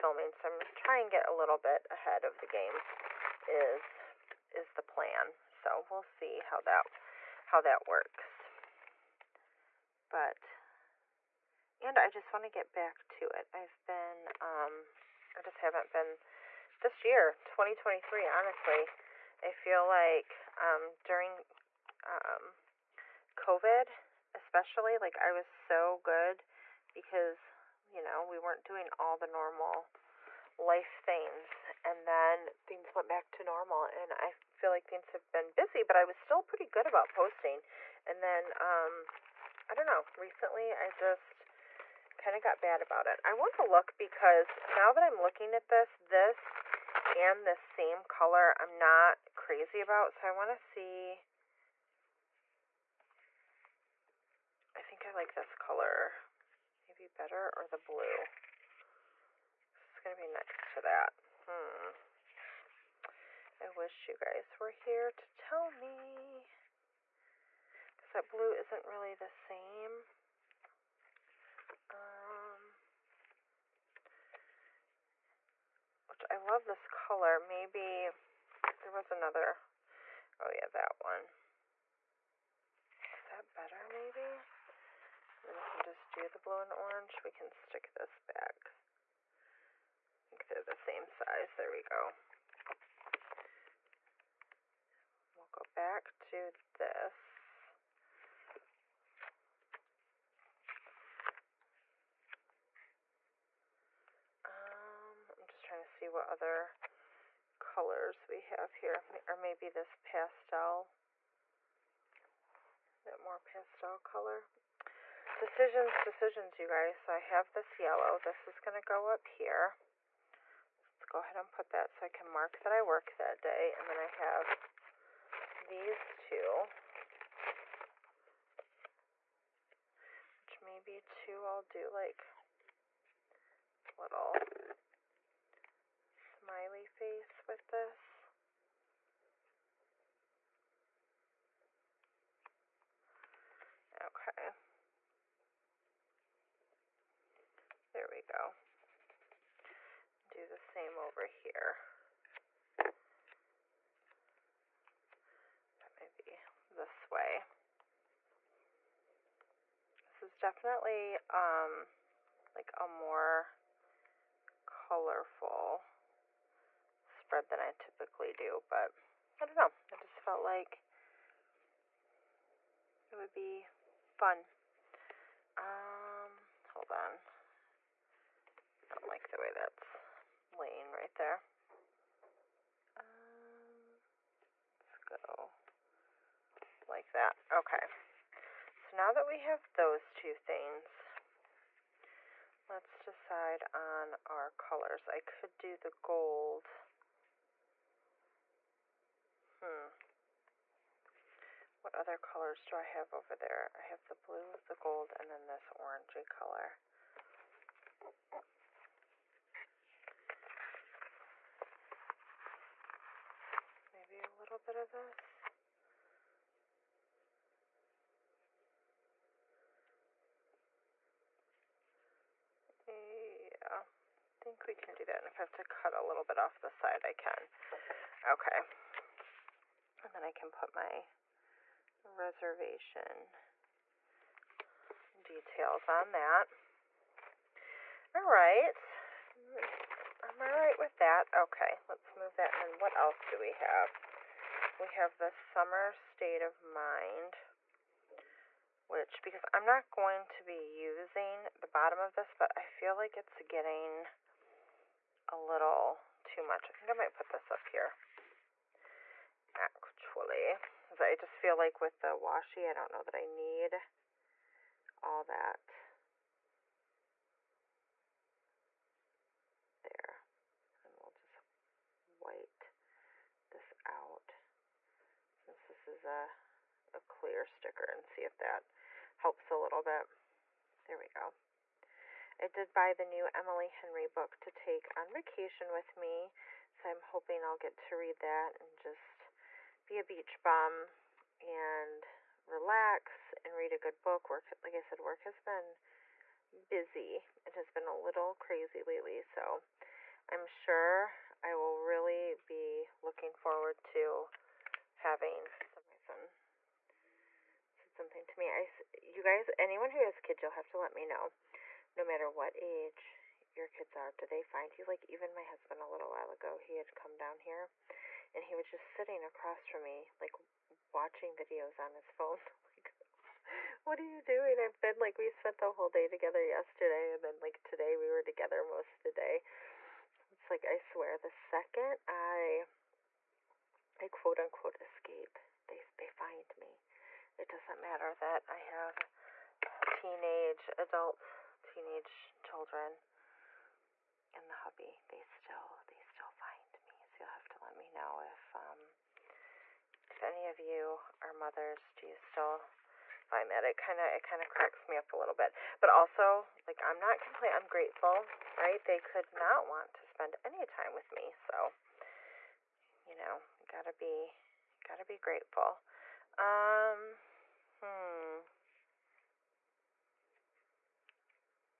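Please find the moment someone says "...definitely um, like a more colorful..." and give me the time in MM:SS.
02:40.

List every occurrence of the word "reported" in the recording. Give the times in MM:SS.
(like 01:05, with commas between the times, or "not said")
not said.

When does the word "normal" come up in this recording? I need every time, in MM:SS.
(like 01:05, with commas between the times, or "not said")
00:29, 00:33.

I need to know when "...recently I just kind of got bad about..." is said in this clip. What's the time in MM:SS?
00:40.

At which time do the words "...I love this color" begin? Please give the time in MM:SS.
01:16.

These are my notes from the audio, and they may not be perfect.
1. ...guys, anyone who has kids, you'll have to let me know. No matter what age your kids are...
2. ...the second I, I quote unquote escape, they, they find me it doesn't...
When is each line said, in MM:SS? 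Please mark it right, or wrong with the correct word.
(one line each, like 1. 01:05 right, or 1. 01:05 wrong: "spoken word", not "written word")
1. 05:09 right
2. 05:31 right.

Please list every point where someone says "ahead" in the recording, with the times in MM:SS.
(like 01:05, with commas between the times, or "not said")
00:01, 02:01.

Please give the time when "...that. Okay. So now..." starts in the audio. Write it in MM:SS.
03:07.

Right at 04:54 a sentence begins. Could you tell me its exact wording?
Work, like I said, work has been busy.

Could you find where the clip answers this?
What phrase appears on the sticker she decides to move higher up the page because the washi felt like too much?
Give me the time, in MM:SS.
04:05.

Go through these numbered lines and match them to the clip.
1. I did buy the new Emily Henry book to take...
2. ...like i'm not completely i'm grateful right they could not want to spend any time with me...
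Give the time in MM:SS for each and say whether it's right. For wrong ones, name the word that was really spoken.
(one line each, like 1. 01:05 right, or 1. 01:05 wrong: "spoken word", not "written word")
1. 04:42 right
2. 05:56 right.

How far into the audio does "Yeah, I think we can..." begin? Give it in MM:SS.
03:42.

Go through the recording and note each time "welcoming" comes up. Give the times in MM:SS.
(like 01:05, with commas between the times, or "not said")
not said.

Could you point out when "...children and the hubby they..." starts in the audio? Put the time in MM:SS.
05:42.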